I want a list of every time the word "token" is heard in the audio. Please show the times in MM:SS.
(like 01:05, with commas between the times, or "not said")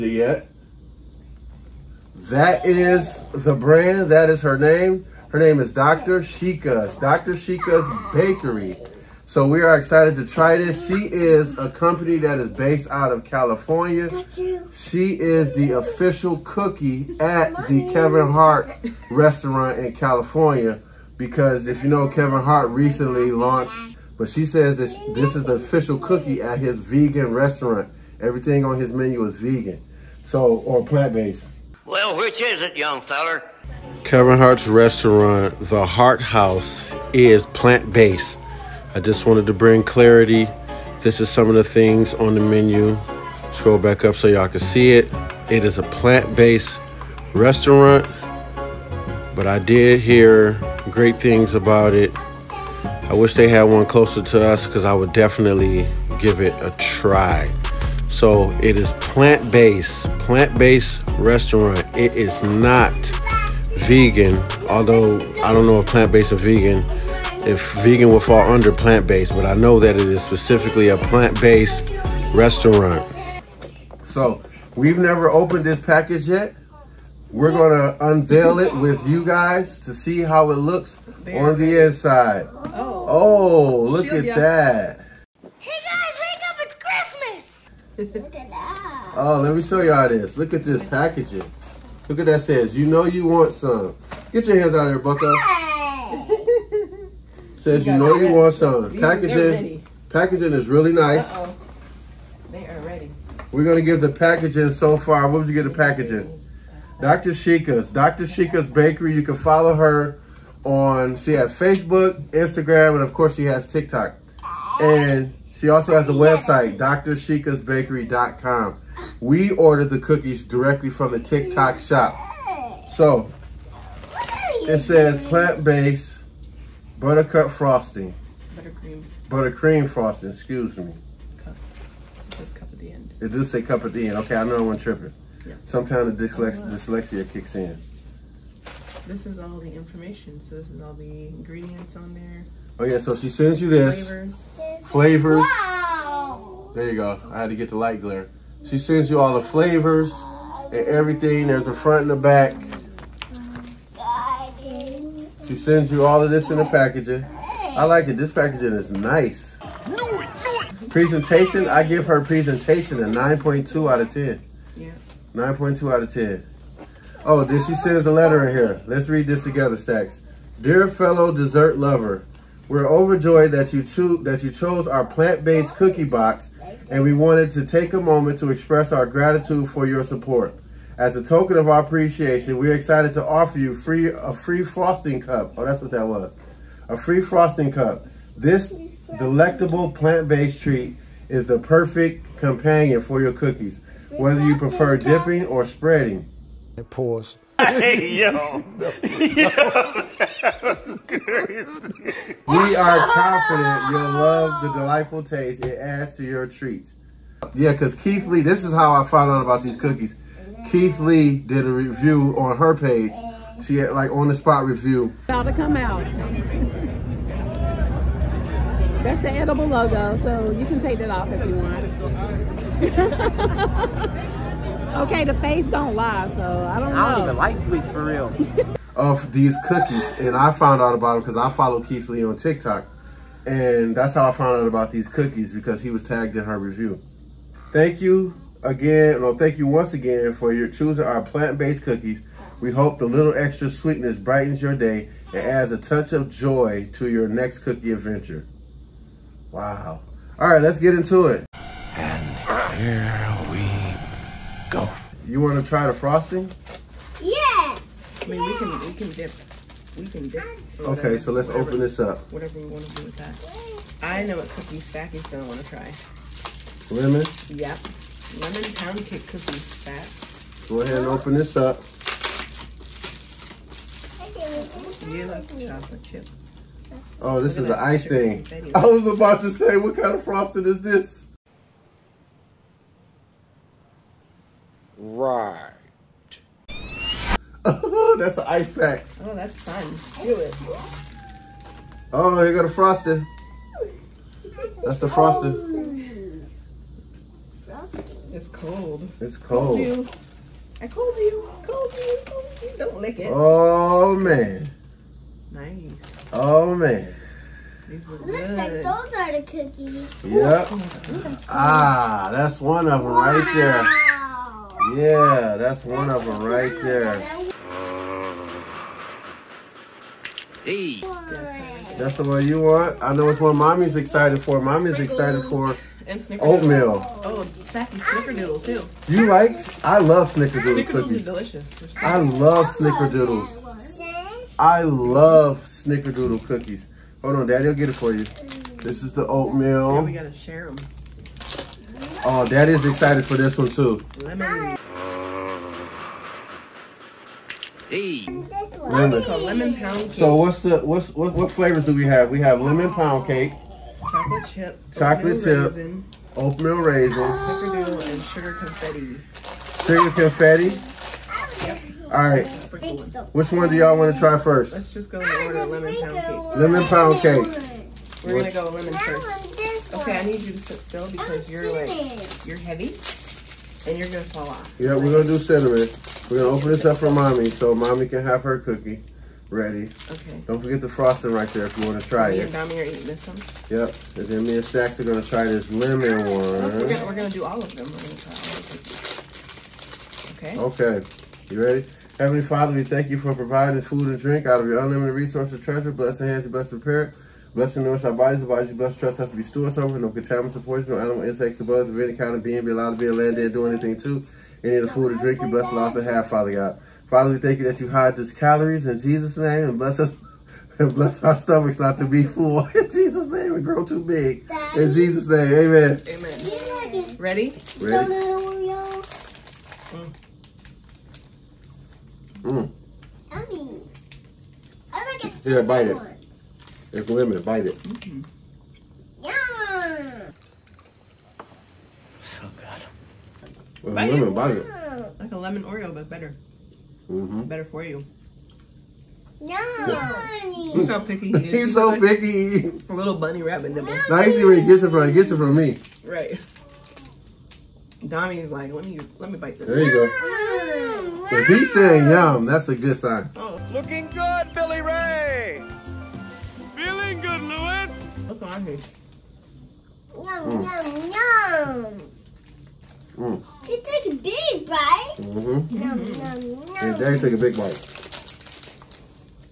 03:01.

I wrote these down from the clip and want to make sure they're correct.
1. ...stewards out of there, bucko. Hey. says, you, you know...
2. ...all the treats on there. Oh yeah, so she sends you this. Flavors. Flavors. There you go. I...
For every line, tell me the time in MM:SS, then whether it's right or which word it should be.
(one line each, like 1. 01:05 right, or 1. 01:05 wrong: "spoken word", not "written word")
1. 01:34 wrong: "hands", not "stewards"
2. 02:20 wrong: "ingredients", not "treats".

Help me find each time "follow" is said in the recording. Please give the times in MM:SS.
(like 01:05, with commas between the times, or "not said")
01:49, 03:51.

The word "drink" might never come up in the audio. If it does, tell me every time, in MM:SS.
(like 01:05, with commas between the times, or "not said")
06:34, 06:45.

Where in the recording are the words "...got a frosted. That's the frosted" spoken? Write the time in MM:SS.
04:52.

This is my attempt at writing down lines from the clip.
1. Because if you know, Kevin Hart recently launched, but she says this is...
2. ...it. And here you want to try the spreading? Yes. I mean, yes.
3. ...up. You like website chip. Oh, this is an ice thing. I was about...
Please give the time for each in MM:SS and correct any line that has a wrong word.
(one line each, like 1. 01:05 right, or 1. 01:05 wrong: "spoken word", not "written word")
1. 00:21 right
2. 04:11 wrong: "frosting", not "spreading"
3. 04:31 wrong: "chocolate", not "website".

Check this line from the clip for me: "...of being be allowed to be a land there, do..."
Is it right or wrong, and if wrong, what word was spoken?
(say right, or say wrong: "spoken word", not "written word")
right.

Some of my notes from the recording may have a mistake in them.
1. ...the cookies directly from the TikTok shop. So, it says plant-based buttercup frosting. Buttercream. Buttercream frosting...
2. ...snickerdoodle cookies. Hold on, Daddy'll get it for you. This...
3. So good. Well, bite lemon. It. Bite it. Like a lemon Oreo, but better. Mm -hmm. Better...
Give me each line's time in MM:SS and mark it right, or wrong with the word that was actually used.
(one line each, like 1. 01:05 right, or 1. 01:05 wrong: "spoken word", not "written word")
1. 01:59 right
2. 05:35 right
3. 07:12 right.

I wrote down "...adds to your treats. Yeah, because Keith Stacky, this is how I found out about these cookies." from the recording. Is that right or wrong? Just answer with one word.
wrong.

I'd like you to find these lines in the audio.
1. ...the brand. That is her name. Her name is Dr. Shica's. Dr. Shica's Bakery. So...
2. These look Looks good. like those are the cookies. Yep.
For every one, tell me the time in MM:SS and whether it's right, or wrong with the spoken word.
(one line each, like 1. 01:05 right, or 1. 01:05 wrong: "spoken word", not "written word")
1. 00:03 right
2. 05:07 right.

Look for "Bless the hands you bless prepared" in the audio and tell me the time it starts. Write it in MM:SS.
06:35.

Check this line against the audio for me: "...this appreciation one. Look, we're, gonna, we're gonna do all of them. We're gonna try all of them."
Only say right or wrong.
wrong.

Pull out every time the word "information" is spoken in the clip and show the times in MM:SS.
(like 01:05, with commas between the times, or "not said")
02:19.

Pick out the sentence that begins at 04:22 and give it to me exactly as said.
Whatever we want to do with that.